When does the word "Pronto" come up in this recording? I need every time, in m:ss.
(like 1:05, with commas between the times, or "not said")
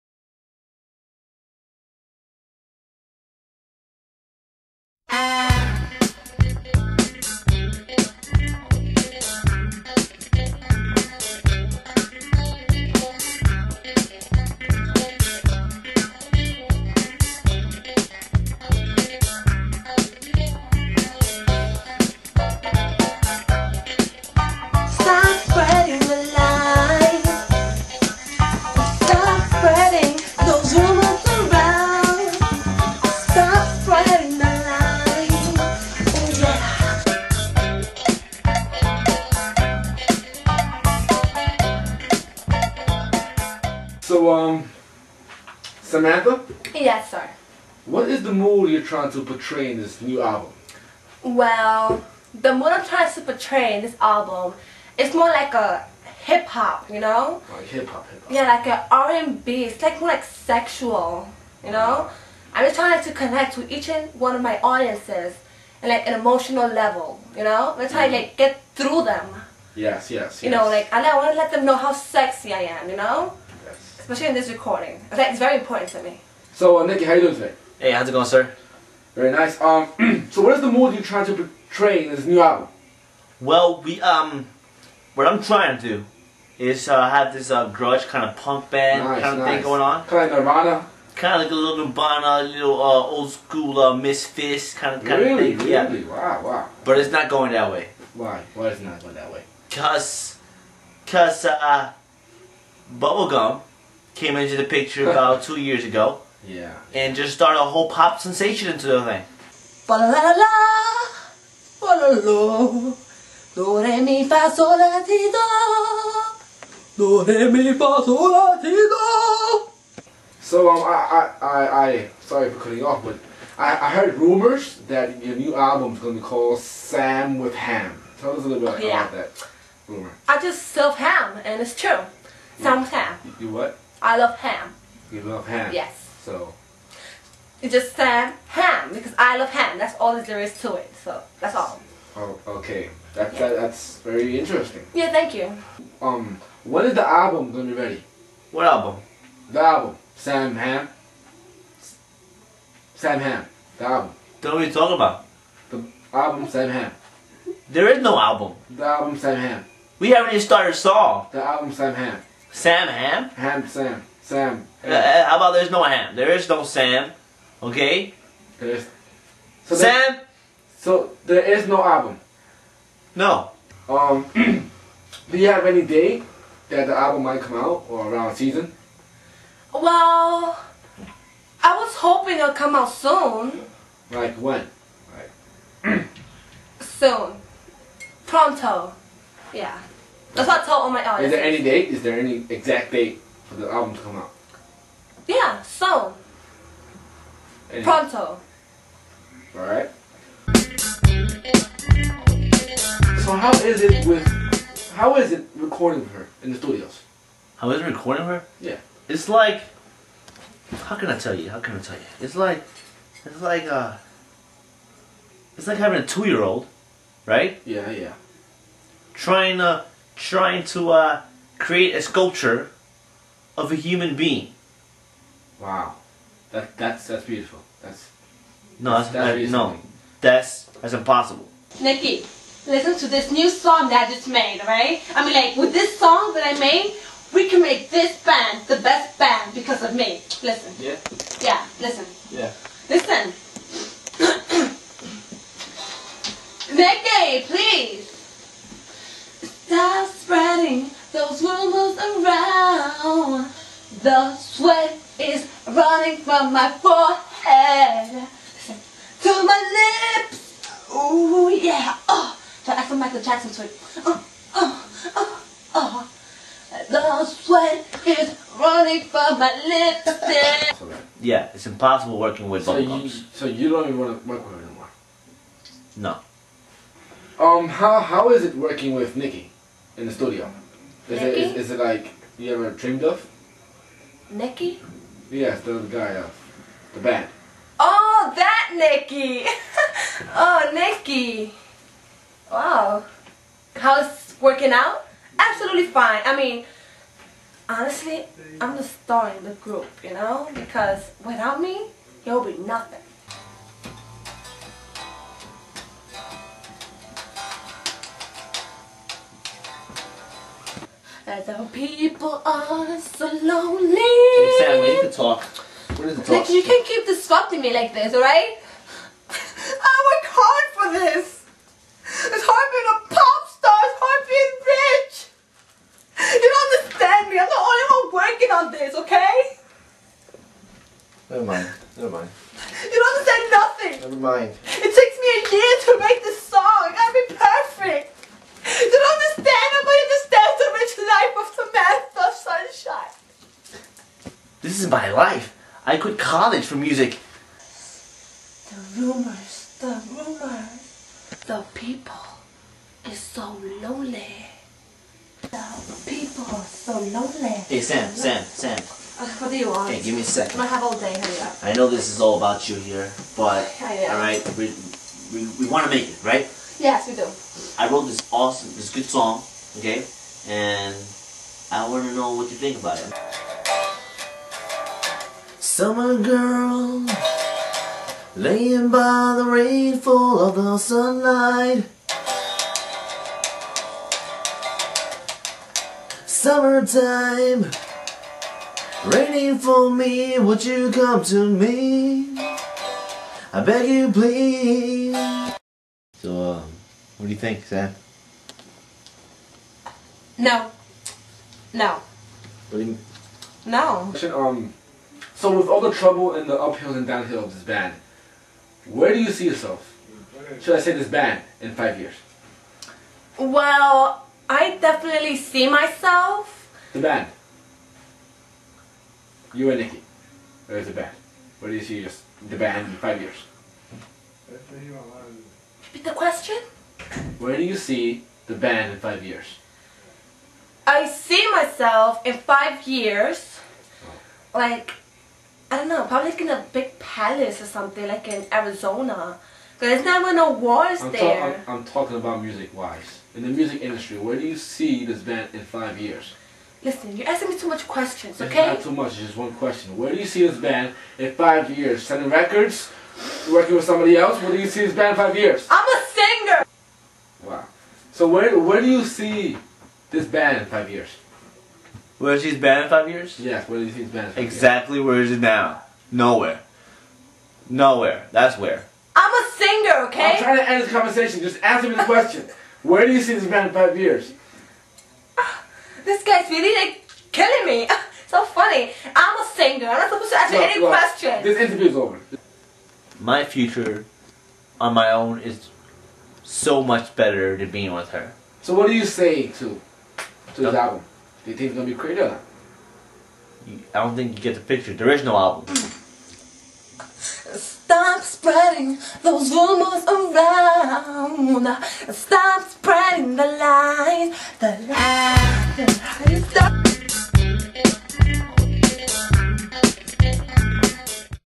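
3:08, 3:17.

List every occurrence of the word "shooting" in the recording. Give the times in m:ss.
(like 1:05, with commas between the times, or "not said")
not said.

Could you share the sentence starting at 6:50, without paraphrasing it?
Should I say this band in five years?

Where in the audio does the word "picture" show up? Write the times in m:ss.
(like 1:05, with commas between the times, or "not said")
1:44, 8:14.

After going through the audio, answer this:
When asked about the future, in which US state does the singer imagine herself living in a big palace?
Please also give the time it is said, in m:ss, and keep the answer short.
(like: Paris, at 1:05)
Arizona, at 7:18.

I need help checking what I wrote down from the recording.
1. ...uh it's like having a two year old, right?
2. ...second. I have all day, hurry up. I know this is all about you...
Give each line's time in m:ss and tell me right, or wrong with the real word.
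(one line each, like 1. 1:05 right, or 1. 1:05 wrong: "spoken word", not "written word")
1. 3:33 right
2. 6:00 right.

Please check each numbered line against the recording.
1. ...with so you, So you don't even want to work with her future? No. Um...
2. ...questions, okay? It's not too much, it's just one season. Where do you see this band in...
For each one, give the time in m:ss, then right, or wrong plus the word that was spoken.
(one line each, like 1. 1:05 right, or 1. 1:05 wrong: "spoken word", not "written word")
1. 4:32 wrong: "anymore", not "future"
2. 7:27 wrong: "question", not "season".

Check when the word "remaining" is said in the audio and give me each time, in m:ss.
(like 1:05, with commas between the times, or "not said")
not said.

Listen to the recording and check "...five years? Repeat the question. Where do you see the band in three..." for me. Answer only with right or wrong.
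wrong.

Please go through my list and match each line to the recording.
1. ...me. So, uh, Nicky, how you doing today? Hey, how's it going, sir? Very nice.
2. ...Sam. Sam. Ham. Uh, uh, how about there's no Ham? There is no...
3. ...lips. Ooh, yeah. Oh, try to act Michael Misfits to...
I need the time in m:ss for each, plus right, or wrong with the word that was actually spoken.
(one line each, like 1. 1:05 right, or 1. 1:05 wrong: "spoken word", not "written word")
1. 1:16 right
2. 2:43 right
3. 4:20 wrong: "Jackson", not "Misfits".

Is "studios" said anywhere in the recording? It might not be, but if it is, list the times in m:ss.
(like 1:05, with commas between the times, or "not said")
3:26, 4:40.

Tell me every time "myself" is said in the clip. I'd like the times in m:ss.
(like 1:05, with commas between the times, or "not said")
6:55, 7:11.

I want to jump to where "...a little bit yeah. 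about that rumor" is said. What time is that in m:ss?
2:08.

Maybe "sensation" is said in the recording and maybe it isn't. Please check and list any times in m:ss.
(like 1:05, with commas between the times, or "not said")
1:48.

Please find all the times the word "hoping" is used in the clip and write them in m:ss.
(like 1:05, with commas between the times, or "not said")
3:01.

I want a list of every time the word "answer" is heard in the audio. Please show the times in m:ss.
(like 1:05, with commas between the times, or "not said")
8:00.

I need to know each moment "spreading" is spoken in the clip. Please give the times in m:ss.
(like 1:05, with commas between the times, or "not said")
4:10, 8:18, 8:22.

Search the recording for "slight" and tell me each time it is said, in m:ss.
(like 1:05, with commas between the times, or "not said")
not said.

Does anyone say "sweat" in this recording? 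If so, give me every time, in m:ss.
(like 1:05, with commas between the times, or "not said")
4:14, 4:27.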